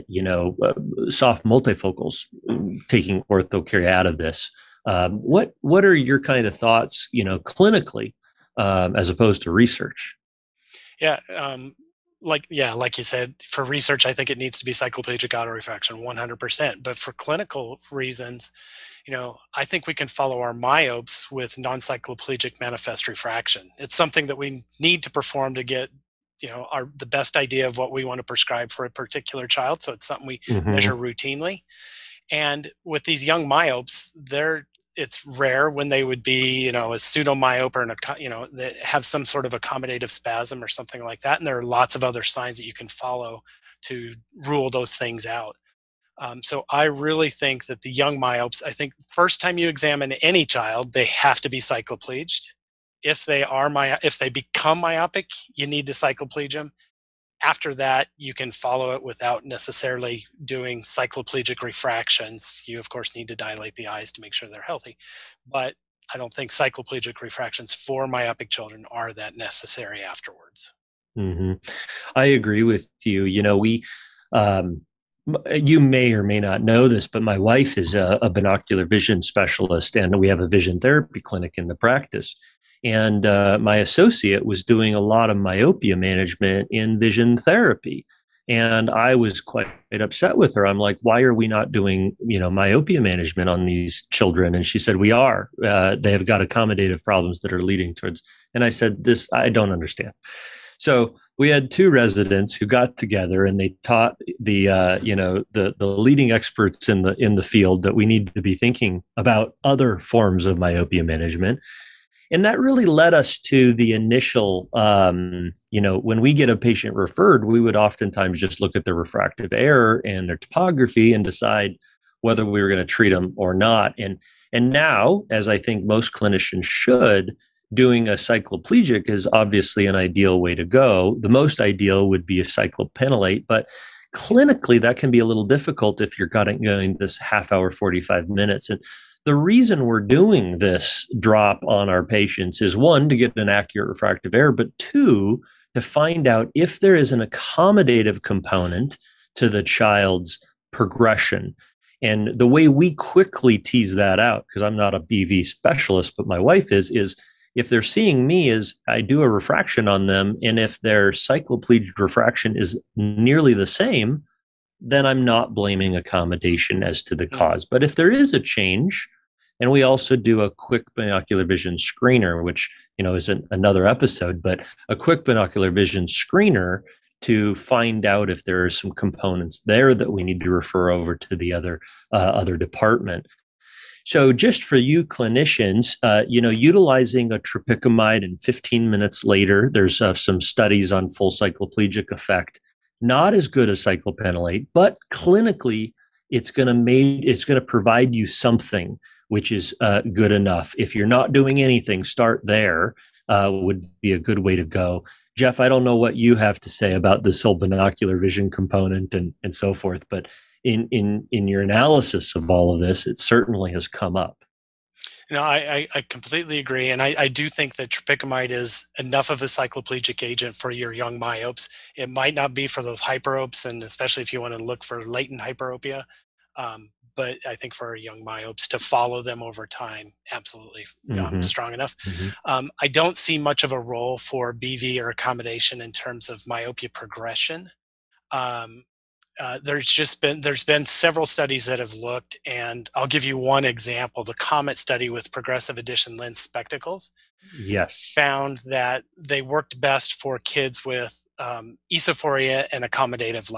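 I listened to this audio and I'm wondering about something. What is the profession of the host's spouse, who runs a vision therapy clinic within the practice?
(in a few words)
Binocular vision specialist.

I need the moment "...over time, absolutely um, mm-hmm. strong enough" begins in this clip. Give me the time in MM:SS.
03:49.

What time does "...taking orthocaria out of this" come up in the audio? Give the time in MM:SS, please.
00:02.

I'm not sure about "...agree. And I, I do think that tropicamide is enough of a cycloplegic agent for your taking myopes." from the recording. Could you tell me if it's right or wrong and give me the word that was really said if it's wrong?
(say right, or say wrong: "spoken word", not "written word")
wrong: "young", not "taking".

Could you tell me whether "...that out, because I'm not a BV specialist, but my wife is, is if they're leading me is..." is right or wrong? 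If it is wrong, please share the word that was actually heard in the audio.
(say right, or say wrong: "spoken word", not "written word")
wrong: "seeing", not "leading".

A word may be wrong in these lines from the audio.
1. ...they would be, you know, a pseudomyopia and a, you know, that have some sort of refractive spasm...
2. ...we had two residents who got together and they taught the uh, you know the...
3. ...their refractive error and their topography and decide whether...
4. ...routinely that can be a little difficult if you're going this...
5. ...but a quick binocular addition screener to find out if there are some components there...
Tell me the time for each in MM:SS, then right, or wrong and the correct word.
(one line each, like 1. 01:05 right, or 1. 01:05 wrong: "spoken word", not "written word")
1. 00:35 wrong: "accommodative", not "refractive"
2. 01:41 right
3. 01:58 right
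4. 02:14 wrong: "clinically", not "routinely"
5. 02:54 wrong: "vision", not "addition".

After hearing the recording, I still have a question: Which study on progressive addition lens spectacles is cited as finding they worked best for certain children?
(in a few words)
COMET study.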